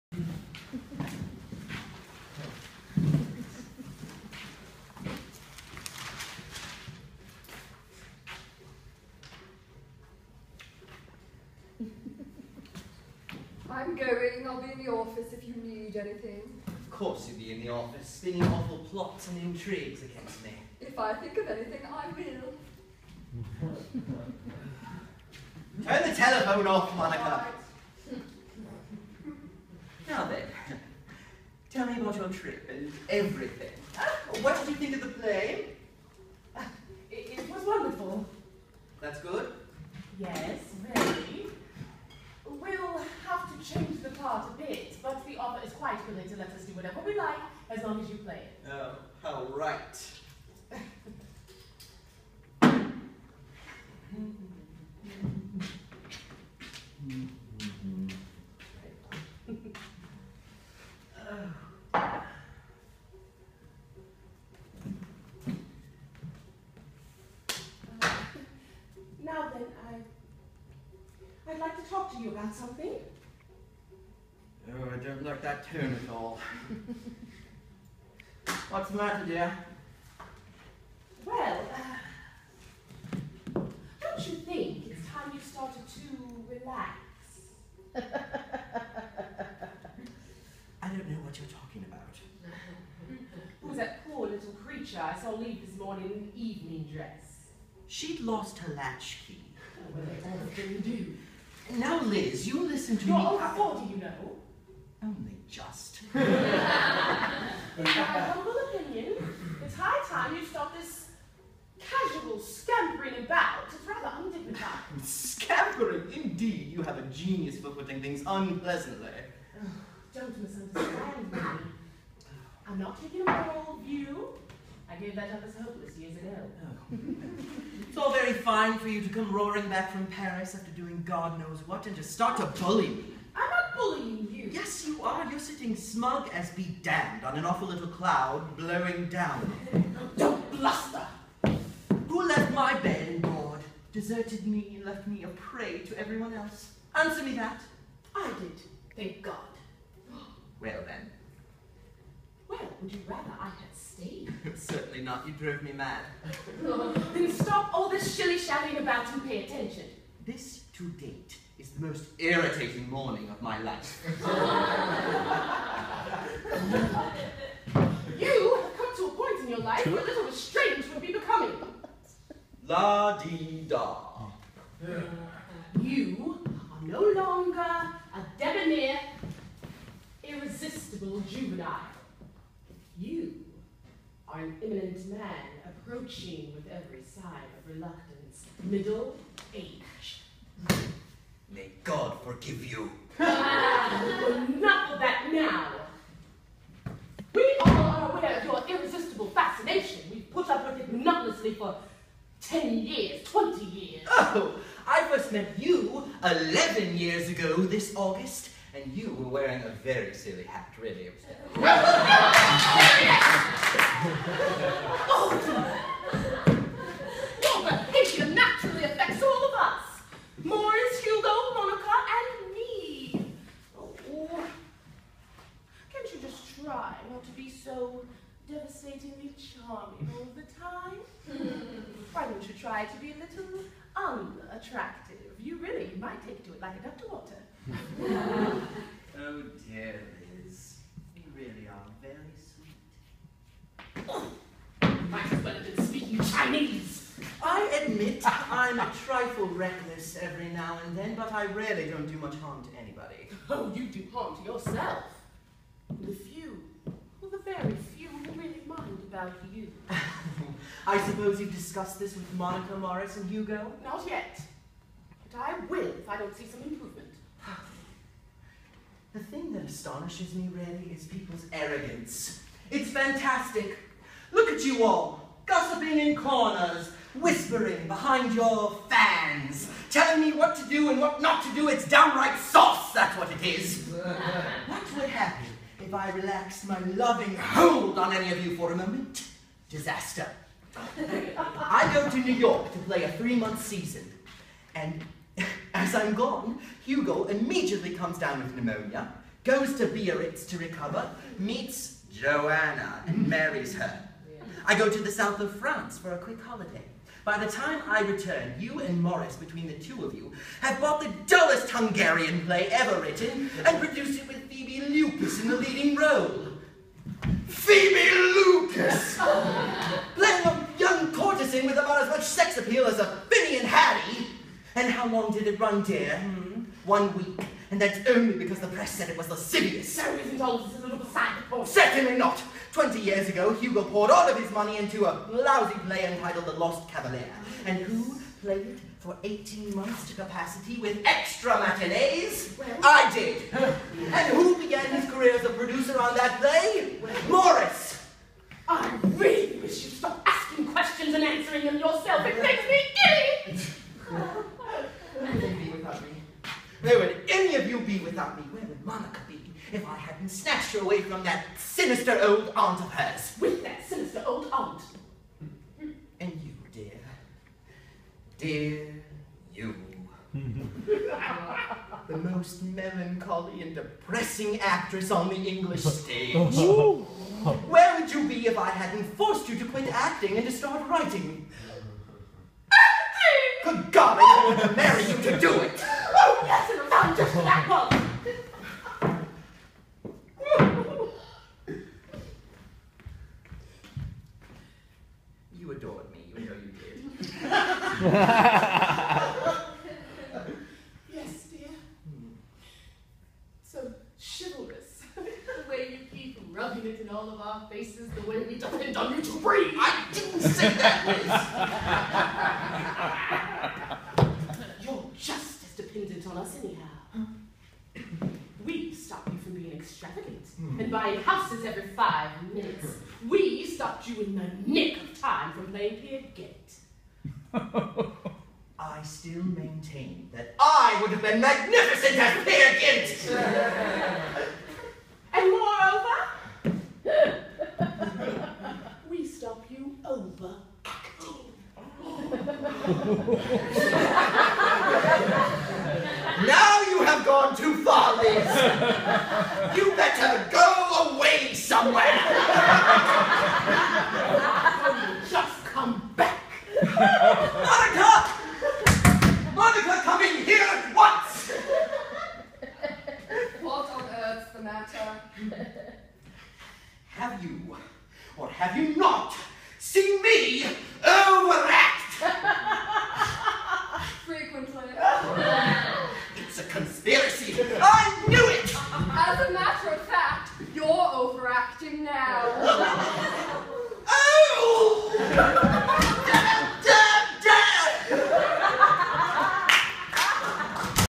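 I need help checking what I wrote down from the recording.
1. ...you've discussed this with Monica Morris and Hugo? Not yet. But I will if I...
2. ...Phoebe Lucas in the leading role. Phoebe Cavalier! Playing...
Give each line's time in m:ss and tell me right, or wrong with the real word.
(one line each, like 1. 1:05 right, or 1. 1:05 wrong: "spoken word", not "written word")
1. 4:21 right
2. 5:14 wrong: "Lucas", not "Cavalier".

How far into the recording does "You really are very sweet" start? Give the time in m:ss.
4:01.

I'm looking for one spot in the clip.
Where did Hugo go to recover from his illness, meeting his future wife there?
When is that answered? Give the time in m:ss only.
4:59.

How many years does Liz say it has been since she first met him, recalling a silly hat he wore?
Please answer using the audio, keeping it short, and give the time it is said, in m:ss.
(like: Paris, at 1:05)
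11, at 3:26.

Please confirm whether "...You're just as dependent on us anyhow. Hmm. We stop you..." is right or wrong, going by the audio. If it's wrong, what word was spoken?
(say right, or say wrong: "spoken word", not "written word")
right.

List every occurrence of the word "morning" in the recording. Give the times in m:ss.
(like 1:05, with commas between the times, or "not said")
1:35, 2:42.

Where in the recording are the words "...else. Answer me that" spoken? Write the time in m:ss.
2:26.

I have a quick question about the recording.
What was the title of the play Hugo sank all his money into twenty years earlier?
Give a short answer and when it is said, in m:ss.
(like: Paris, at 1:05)
The Lost Cavalier, at 5:36.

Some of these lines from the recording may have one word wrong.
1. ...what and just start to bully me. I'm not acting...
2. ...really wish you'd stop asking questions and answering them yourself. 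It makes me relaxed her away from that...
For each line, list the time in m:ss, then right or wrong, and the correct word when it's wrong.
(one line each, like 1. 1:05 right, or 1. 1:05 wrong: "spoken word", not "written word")
1. 2:11 wrong: "bullying", not "acting"
2. 5:49 wrong: "snatched", not "relaxed".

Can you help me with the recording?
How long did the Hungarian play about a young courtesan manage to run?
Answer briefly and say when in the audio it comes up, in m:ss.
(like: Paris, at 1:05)
One week, at 5:26.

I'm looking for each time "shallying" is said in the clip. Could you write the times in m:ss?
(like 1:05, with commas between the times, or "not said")
2:38.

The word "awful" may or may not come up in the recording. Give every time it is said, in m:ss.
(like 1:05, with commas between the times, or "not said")
0:18, 2:17.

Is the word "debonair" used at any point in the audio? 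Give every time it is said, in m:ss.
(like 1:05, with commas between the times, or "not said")
2:58.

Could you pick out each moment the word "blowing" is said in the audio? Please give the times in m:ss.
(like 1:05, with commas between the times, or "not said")
2:18.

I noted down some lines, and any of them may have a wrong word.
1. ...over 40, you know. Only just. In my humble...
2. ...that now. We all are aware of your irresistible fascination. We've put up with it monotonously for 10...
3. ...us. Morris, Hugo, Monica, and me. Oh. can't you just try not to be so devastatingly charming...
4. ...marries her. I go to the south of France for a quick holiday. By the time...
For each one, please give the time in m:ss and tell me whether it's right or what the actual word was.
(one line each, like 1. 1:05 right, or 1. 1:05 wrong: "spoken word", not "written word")
1. 1:43 right
2. 3:14 right
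3. 3:39 right
4. 5:03 right.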